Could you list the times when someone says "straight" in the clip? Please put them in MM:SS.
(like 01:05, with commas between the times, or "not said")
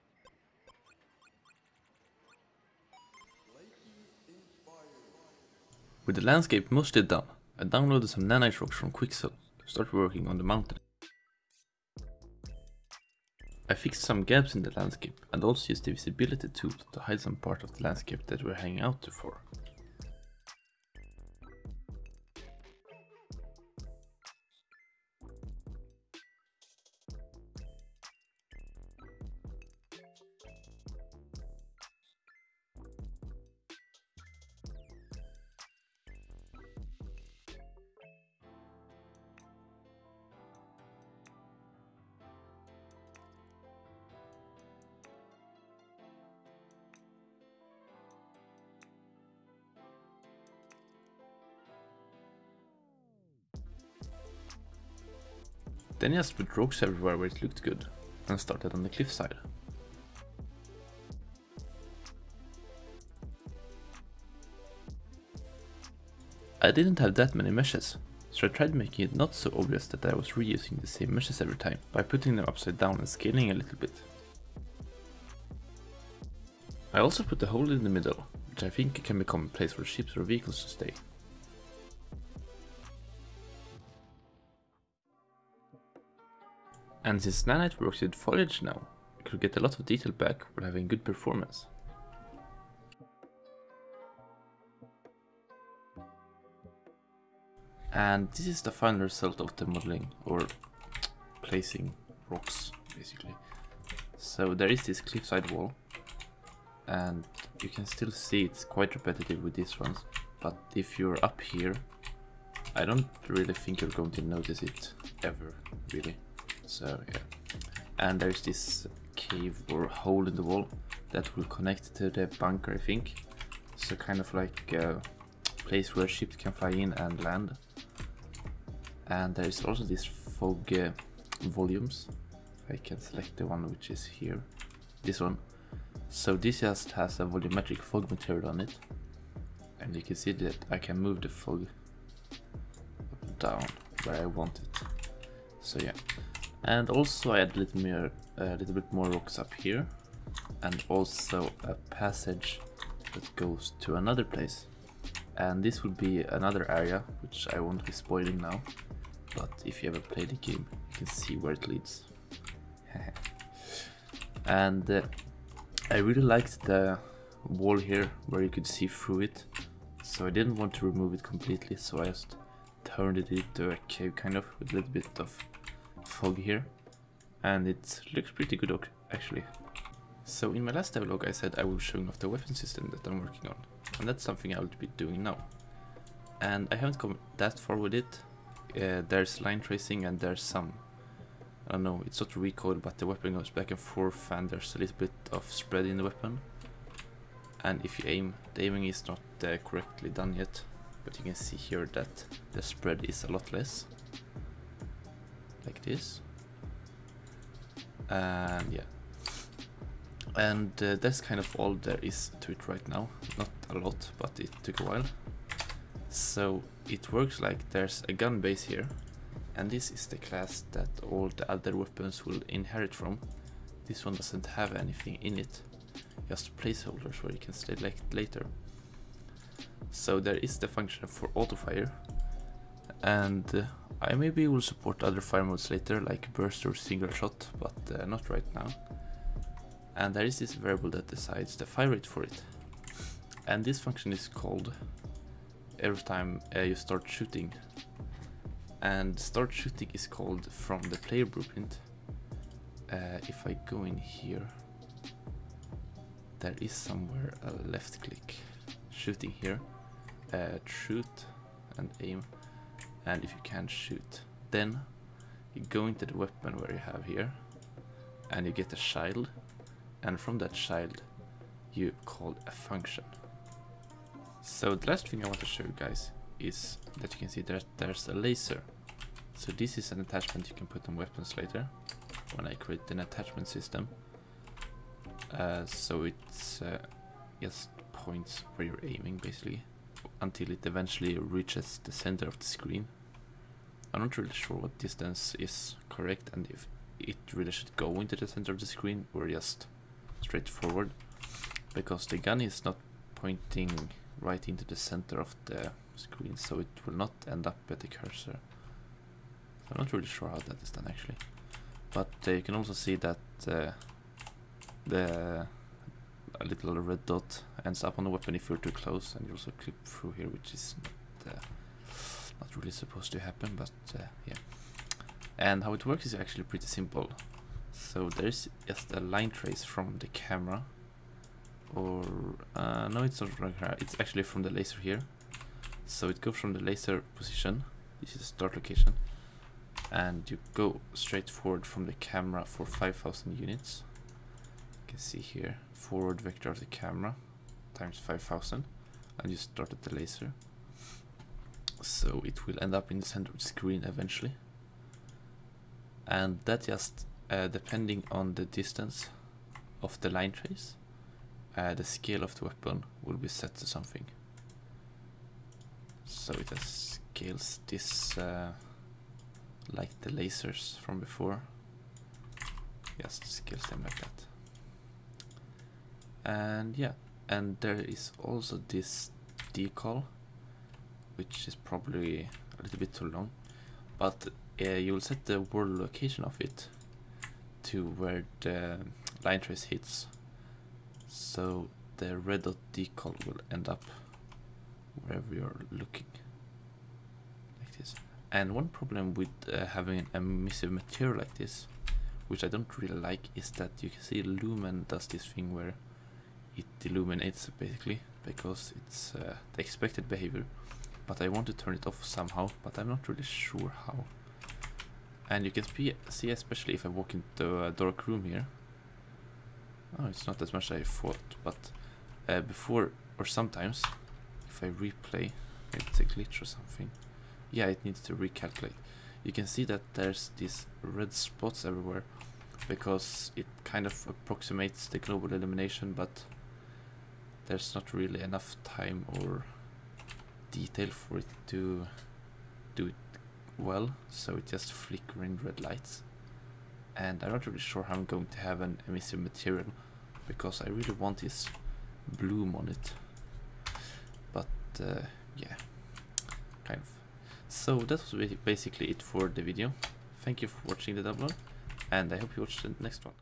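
05:00, 05:40.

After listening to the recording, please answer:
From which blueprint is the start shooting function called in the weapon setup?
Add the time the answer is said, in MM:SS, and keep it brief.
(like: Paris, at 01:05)
player blueprint, at 04:10.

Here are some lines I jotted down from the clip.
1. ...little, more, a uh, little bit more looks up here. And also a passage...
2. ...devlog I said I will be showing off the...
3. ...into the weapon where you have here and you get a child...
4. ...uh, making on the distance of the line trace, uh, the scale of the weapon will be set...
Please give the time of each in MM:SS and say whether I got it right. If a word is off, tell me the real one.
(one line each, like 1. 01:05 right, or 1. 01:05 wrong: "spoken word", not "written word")
1. 02:27 wrong: "rocks", not "looks"
2. 03:00 right
3. 04:25 right
4. 05:57 wrong: "depending", not "making".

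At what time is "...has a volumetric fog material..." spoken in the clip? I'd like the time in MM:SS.
02:16.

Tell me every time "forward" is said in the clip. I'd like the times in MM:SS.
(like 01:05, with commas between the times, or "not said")
05:00, 05:41, 05:45.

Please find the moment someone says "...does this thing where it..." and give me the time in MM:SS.
06:44.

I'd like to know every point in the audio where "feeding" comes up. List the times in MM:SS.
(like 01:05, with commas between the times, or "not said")
not said.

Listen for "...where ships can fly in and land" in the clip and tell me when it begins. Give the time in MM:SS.
02:05.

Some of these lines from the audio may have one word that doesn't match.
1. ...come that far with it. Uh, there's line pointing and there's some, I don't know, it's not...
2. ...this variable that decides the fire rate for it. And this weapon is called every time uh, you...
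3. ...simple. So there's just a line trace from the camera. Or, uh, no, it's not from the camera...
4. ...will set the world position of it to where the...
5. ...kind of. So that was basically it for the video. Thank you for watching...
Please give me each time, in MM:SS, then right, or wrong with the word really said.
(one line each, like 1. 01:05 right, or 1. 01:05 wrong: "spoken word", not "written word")
1. 03:06 wrong: "tracing", not "pointing"
2. 04:00 wrong: "function", not "weapon"
3. 05:26 right
4. 06:24 wrong: "location", not "position"
5. 07:36 right.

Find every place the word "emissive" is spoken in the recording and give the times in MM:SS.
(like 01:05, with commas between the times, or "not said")
06:40, 07:28.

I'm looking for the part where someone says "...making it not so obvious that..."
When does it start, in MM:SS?
01:08.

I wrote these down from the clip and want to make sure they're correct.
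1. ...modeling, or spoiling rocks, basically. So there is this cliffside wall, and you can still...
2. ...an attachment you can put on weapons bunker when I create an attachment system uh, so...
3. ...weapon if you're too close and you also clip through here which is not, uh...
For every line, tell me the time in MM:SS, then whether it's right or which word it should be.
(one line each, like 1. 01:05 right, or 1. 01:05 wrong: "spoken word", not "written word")
1. 01:39 wrong: "placing", not "spoiling"
2. 04:39 wrong: "later", not "bunker"
3. 05:18 right.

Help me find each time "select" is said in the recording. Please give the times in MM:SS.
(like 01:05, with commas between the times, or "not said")
02:12, 03:47.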